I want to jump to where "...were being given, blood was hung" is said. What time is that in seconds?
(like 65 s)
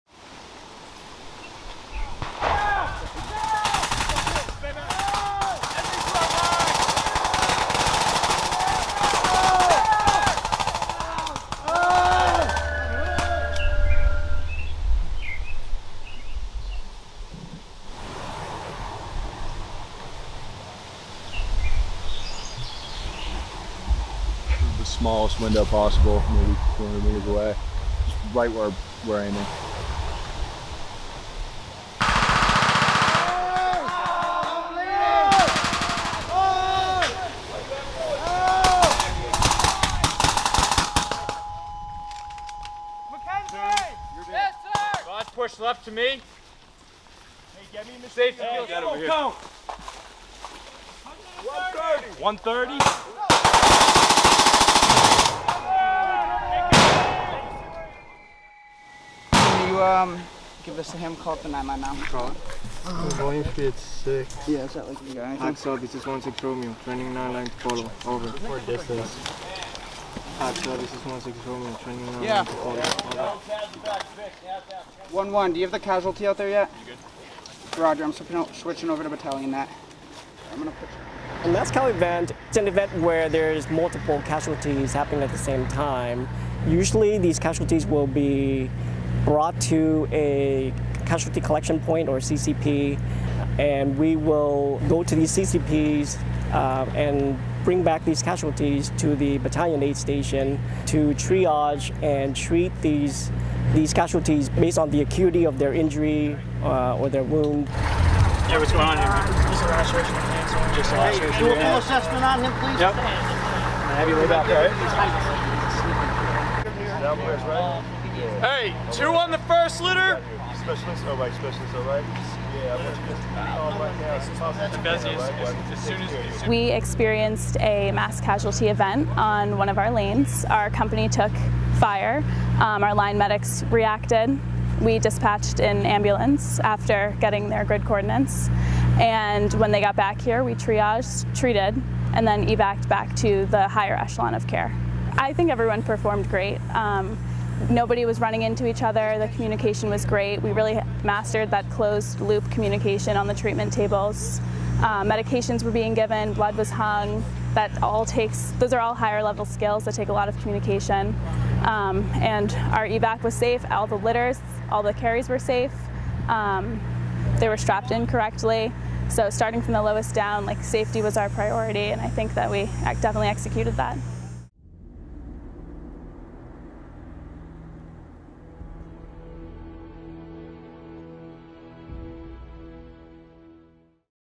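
155 s.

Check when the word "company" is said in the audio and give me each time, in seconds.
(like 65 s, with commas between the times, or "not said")
130 s.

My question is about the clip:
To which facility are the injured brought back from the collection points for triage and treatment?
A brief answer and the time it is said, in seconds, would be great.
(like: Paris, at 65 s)
battalion aid station, at 99 s.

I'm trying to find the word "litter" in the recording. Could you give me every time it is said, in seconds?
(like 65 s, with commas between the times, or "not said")
119 s, 163 s.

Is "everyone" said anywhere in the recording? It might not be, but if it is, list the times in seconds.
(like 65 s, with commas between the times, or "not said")
145 s.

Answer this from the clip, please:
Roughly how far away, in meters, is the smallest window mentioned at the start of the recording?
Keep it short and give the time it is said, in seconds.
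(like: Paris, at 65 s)
200 meters, at 26 s.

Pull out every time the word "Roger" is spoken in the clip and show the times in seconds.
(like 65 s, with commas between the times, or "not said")
77 s.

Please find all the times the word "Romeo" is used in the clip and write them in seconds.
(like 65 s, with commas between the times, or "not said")
66 s, 71 s.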